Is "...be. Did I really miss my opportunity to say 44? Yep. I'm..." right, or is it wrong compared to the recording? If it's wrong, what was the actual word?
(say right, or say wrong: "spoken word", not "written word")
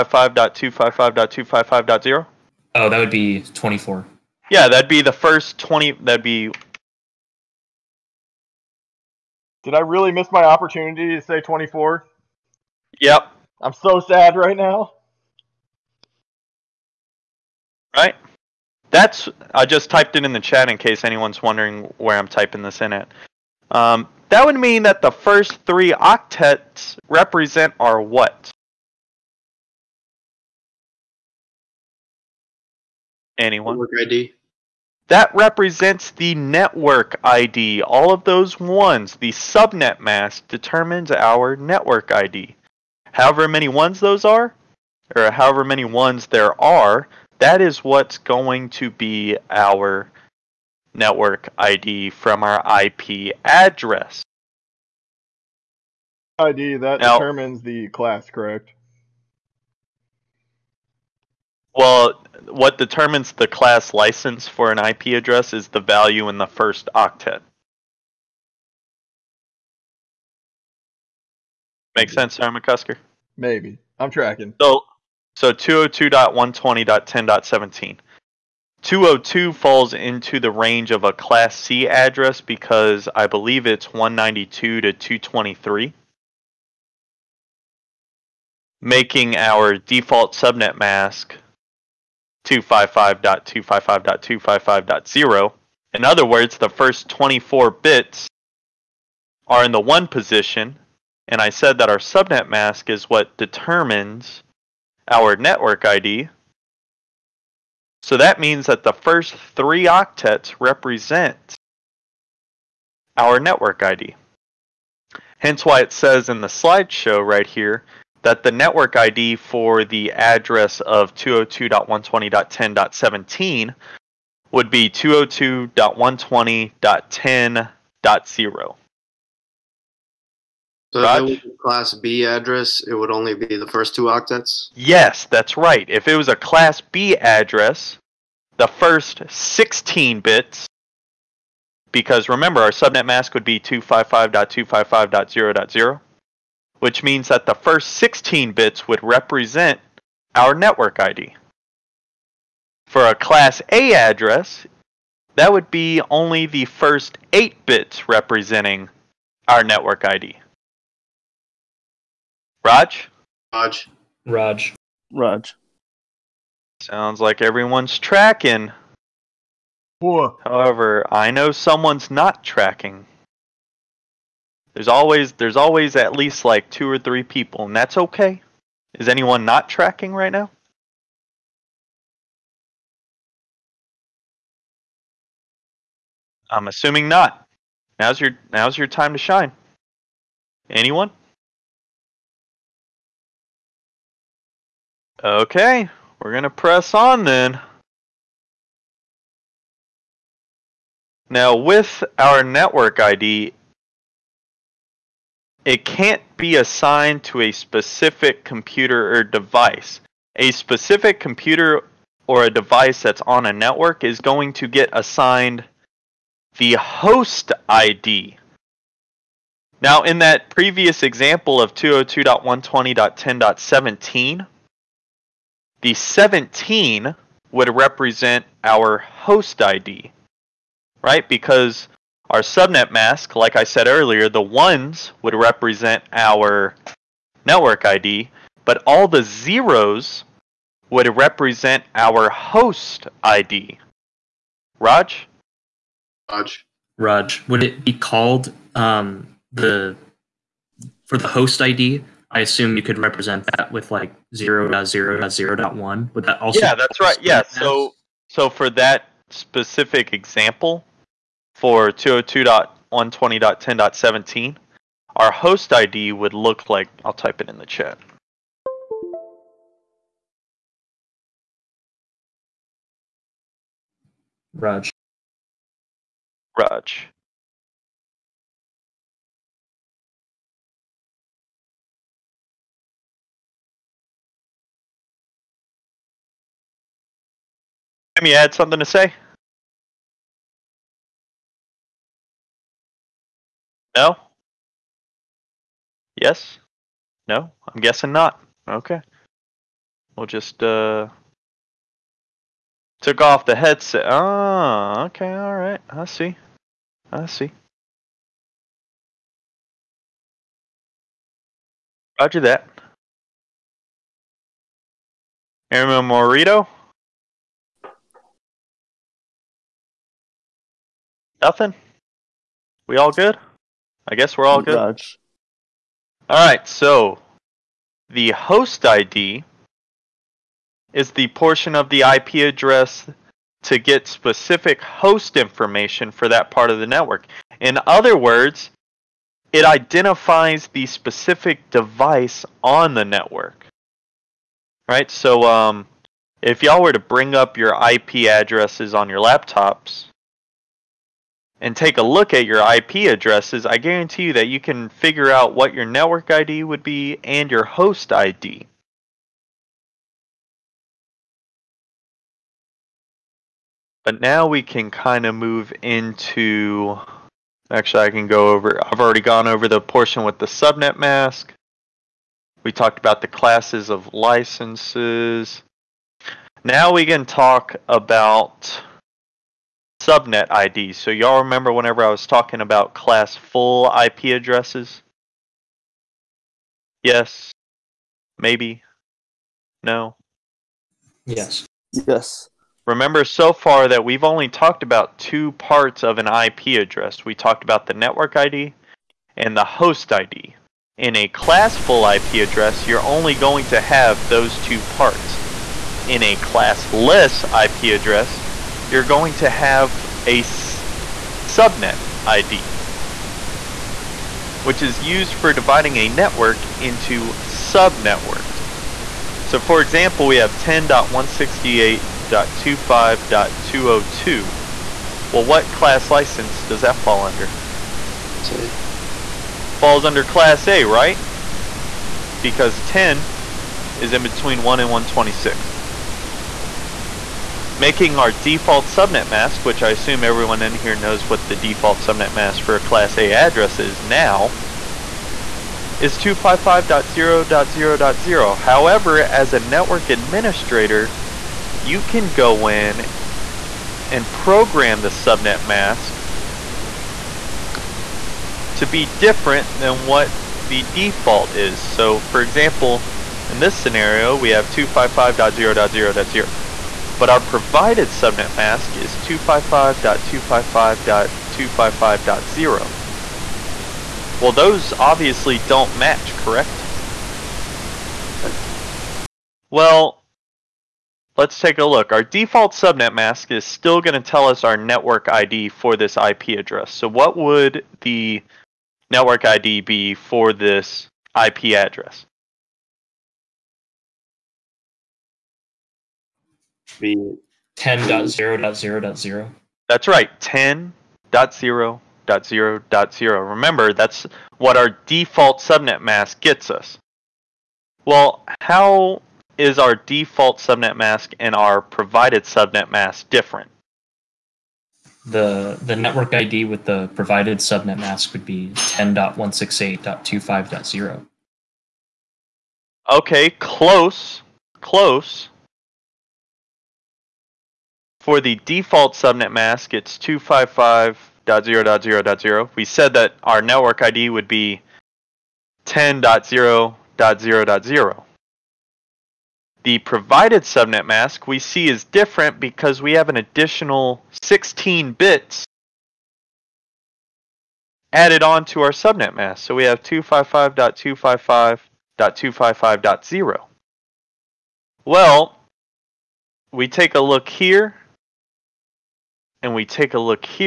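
wrong: "24", not "44".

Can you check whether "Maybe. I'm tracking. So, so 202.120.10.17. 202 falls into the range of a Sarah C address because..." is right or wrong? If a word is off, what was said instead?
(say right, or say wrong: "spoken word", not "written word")
wrong: "Class", not "Sarah".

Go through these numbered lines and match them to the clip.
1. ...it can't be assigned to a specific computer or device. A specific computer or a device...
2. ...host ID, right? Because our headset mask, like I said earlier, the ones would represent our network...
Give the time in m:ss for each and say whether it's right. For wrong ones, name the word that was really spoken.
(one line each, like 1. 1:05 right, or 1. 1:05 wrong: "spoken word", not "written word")
1. 3:25 right
2. 3:48 wrong: "subnet", not "headset".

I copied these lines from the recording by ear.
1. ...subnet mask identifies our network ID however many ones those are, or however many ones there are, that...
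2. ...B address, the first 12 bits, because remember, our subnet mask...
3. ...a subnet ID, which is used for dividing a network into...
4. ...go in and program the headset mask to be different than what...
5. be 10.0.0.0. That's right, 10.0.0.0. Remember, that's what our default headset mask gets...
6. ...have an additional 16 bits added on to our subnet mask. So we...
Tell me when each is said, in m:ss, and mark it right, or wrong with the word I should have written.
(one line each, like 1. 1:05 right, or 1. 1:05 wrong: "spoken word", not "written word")
1. 0:39 wrong: "determines", not "identifies"
2. 2:16 wrong: "16", not "12"
3. 6:50 right
4. 7:32 wrong: "subnet", not "headset"
5. 8:16 wrong: "subnet", not "headset"
6. 9:03 right.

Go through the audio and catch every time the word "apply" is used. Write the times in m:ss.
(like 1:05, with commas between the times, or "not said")
not said.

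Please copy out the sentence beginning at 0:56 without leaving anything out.
ID that now, determines the class, correct?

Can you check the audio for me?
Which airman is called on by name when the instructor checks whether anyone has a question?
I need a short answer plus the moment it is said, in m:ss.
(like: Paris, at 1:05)
Airman Morito, at 5:15.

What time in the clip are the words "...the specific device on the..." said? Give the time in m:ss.
5:40.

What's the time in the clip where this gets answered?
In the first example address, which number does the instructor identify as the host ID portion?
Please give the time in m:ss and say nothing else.
3:45.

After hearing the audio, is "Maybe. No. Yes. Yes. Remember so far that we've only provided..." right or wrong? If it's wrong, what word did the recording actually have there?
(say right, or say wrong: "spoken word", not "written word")
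wrong: "talked", not "provided".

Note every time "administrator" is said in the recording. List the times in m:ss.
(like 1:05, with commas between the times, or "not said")
7:30.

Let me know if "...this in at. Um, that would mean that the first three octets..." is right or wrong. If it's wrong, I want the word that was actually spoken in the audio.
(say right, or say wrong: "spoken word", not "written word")
right.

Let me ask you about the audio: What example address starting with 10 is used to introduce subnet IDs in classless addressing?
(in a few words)
10.168.25.202.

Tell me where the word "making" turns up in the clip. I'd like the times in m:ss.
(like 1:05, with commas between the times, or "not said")
1:28, 7:17.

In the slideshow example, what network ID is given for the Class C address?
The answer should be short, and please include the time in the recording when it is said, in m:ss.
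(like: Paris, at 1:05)
202.120.10.0, at 2:04.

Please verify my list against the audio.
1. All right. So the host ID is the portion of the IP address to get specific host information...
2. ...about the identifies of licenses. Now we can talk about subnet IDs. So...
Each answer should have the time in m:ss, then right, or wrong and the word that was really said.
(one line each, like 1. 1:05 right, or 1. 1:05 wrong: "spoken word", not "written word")
1. 5:24 right
2. 6:12 wrong: "classes", not "identifies".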